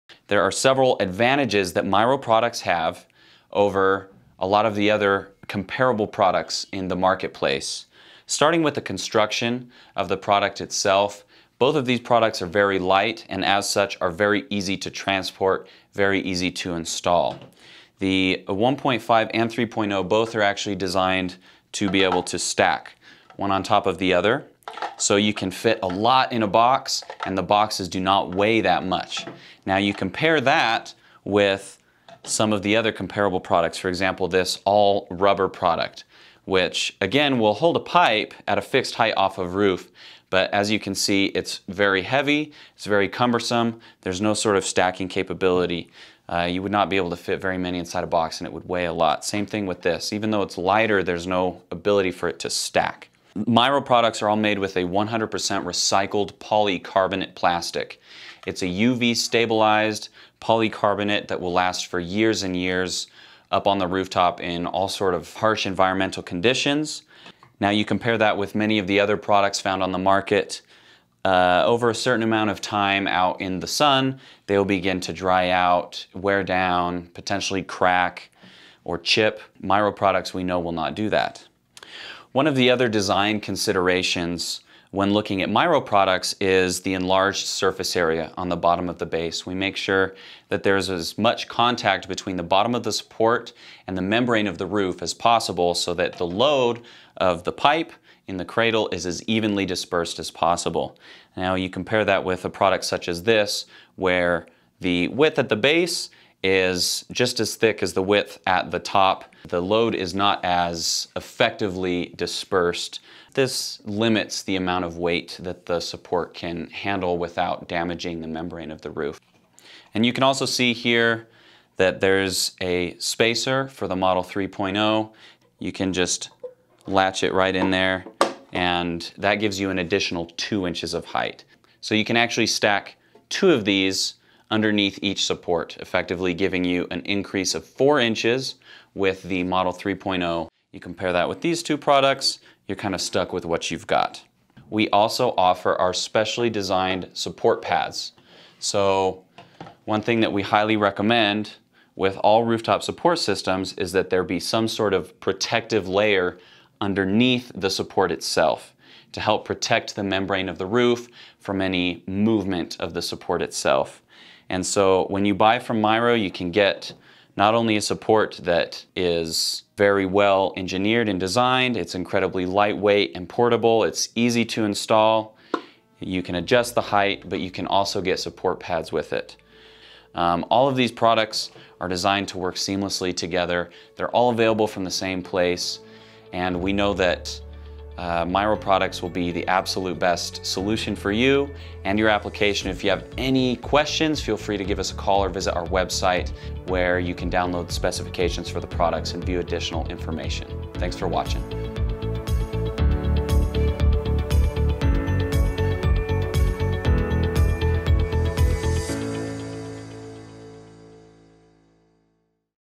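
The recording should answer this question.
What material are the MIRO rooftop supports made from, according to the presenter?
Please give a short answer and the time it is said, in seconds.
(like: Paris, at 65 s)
100% recycled polycarbonate plastic, at 54 s.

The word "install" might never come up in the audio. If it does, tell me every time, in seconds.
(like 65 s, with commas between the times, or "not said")
16 s, 174 s.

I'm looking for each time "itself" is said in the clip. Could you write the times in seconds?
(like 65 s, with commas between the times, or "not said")
10 s, 158 s, 163 s.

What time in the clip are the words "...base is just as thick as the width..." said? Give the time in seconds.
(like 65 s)
105 s.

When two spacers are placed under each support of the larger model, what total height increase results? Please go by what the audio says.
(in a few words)
4 inches.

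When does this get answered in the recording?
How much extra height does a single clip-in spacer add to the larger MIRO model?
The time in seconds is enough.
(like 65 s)
130 s.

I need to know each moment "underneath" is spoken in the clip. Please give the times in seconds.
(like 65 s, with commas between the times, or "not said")
134 s, 156 s.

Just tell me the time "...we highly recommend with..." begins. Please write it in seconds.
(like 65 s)
150 s.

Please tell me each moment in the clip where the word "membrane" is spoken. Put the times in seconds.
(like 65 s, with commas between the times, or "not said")
94 s, 118 s, 160 s.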